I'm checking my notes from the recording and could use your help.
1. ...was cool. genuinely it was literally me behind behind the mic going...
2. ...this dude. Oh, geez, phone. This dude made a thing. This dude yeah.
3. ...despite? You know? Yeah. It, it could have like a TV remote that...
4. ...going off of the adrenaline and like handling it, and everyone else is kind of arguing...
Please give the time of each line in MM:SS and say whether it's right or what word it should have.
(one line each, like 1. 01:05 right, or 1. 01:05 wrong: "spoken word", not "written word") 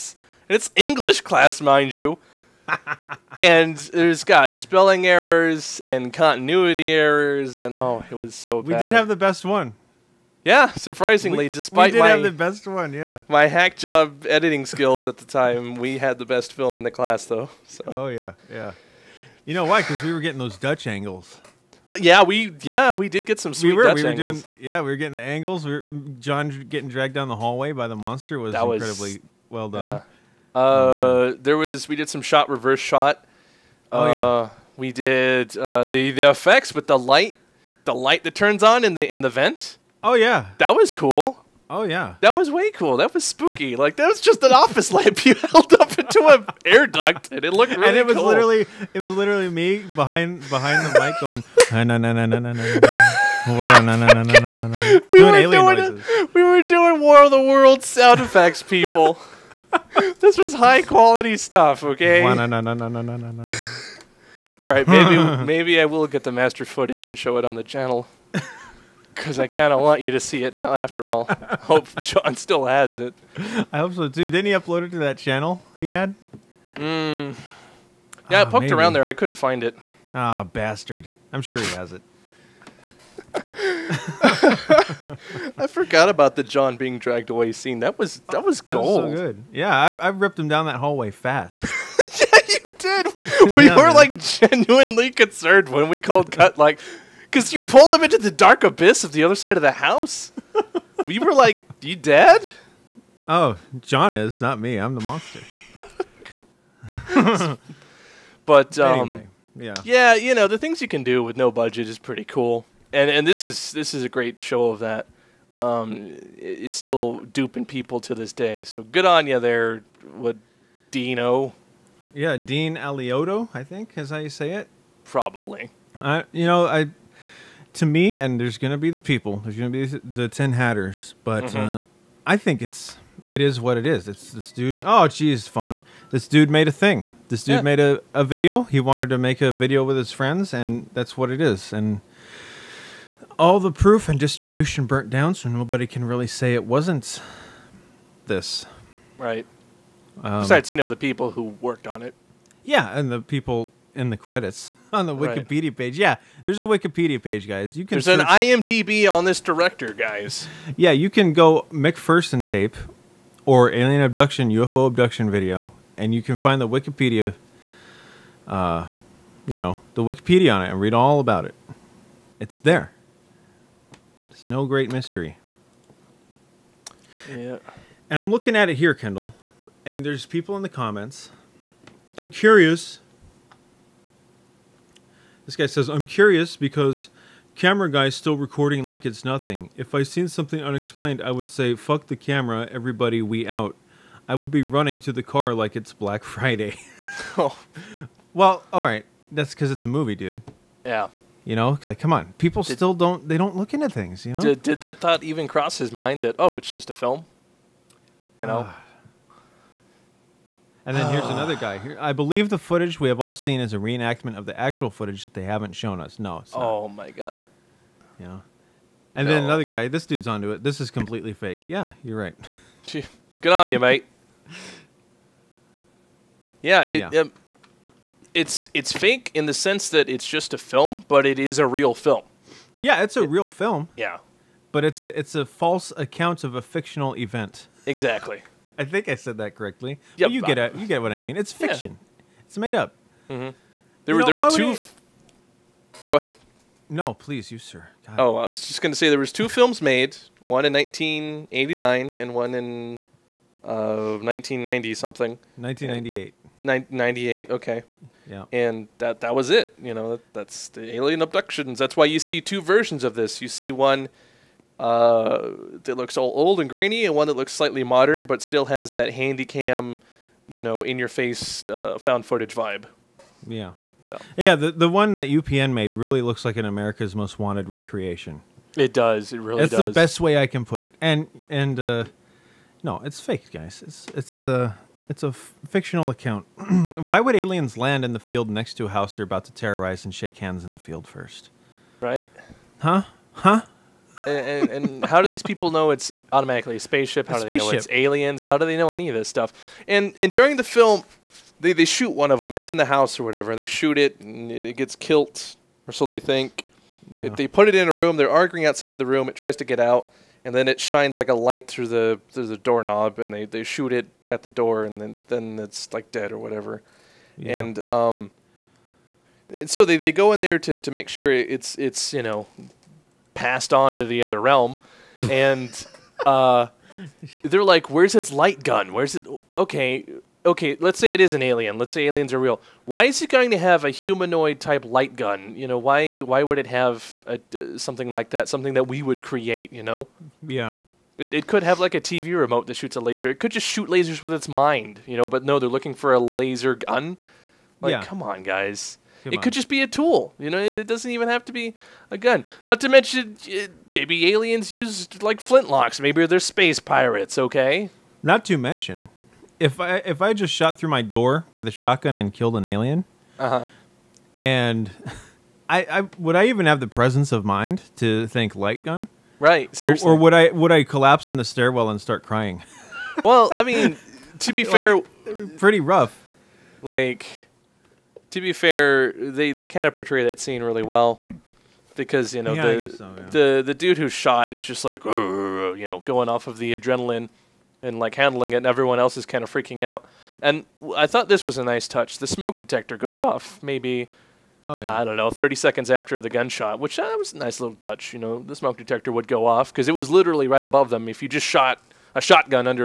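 1. 00:48 wrong: "literally", not "genuinely"
2. 02:14 right
3. 05:39 wrong: "create", not "despite"
4. 06:26 wrong: "freaking", not "arguing".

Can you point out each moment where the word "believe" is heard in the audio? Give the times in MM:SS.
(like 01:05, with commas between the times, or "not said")
03:32.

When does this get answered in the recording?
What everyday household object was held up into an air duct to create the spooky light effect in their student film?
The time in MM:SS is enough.
00:44.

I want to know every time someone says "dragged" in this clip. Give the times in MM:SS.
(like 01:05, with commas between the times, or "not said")
00:26, 01:26.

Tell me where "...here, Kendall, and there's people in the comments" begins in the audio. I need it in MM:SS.
02:58.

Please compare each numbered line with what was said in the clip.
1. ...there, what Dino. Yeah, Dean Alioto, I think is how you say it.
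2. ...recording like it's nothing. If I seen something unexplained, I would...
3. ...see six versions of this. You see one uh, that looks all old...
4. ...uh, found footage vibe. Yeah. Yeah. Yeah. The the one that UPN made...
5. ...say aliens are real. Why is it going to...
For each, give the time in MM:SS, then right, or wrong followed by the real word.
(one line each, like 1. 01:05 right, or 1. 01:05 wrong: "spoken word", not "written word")
1. 01:59 right
2. 03:08 right
3. 04:22 wrong: "two", not "six"
4. 04:31 right
5. 05:31 right.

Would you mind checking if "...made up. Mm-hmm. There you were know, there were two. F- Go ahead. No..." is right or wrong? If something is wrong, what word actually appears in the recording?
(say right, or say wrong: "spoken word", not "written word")
right.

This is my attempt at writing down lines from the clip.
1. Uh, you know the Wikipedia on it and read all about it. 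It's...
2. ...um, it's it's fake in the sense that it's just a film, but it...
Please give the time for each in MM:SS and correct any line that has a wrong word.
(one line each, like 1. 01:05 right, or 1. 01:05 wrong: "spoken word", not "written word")
1. 02:48 right
2. 03:47 right.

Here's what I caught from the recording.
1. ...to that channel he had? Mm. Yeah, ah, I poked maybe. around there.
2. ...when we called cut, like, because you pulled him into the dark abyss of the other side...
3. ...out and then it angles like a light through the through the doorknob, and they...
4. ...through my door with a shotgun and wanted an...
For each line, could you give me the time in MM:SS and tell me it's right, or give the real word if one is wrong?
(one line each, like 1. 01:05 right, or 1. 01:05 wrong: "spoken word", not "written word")
1. 01:14 right
2. 01:35 right
3. 05:09 wrong: "shines", not "angles"
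4. 06:00 wrong: "killed", not "wanted".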